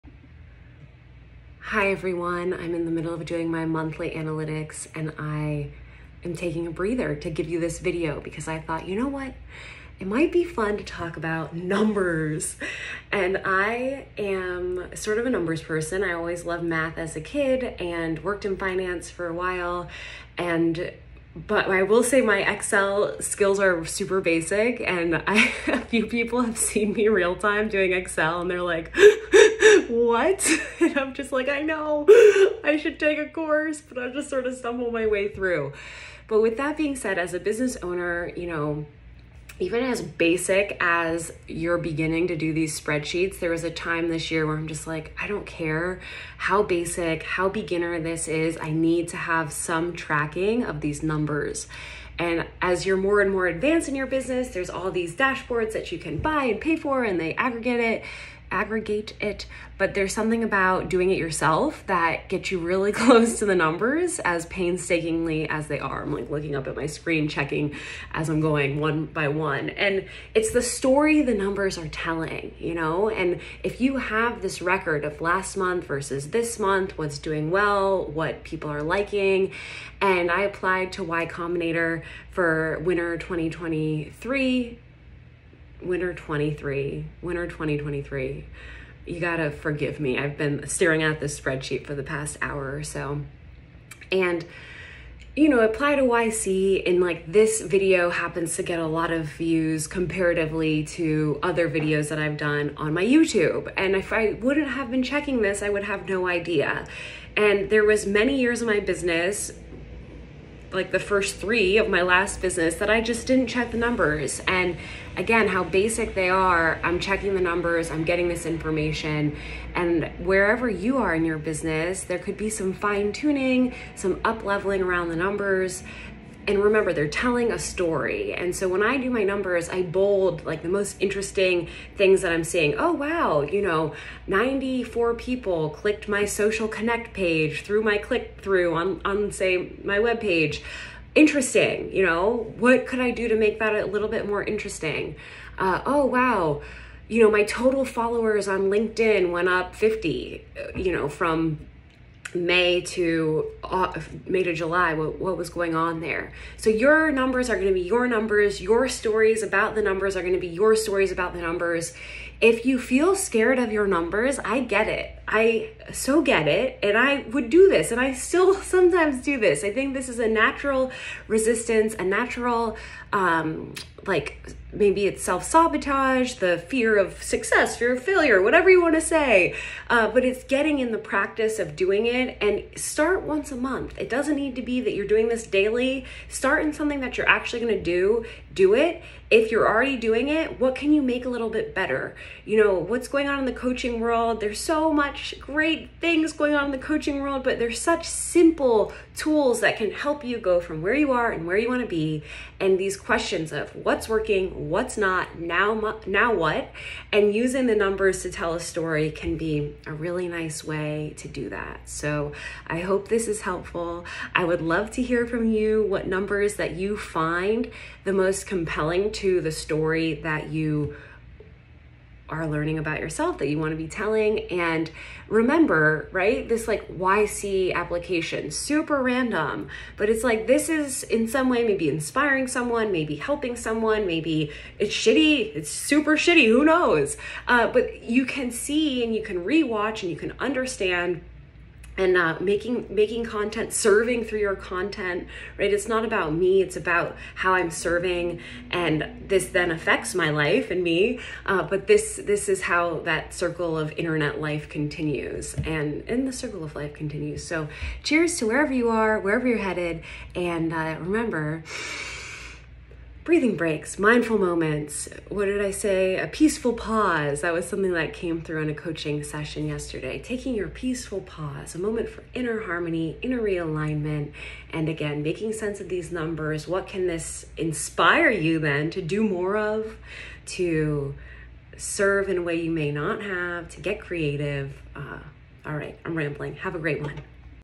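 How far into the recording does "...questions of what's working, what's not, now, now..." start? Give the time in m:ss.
3:22.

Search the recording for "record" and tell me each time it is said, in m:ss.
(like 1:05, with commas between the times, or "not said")
1:14.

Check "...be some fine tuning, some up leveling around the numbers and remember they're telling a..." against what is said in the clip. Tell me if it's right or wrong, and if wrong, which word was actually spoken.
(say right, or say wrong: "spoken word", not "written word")
right.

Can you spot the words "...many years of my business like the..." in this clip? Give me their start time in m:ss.
1:48.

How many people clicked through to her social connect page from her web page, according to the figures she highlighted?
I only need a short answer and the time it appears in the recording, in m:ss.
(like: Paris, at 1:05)
94, at 2:14.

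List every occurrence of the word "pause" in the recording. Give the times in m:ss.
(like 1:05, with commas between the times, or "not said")
4:26, 4:31.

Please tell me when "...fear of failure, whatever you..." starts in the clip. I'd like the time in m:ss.
2:57.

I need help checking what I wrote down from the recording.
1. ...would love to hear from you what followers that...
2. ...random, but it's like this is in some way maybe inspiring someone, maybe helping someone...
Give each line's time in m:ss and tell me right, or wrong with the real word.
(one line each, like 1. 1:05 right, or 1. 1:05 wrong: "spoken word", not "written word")
1. 3:34 wrong: "numbers", not "followers"
2. 3:49 right.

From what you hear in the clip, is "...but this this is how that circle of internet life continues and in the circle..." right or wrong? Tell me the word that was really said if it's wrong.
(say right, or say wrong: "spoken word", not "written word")
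right.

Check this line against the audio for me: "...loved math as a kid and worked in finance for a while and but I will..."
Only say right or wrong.
right.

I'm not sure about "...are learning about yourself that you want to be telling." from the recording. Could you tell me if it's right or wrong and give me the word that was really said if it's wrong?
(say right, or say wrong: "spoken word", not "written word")
right.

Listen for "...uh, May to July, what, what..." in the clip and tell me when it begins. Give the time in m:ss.
2:33.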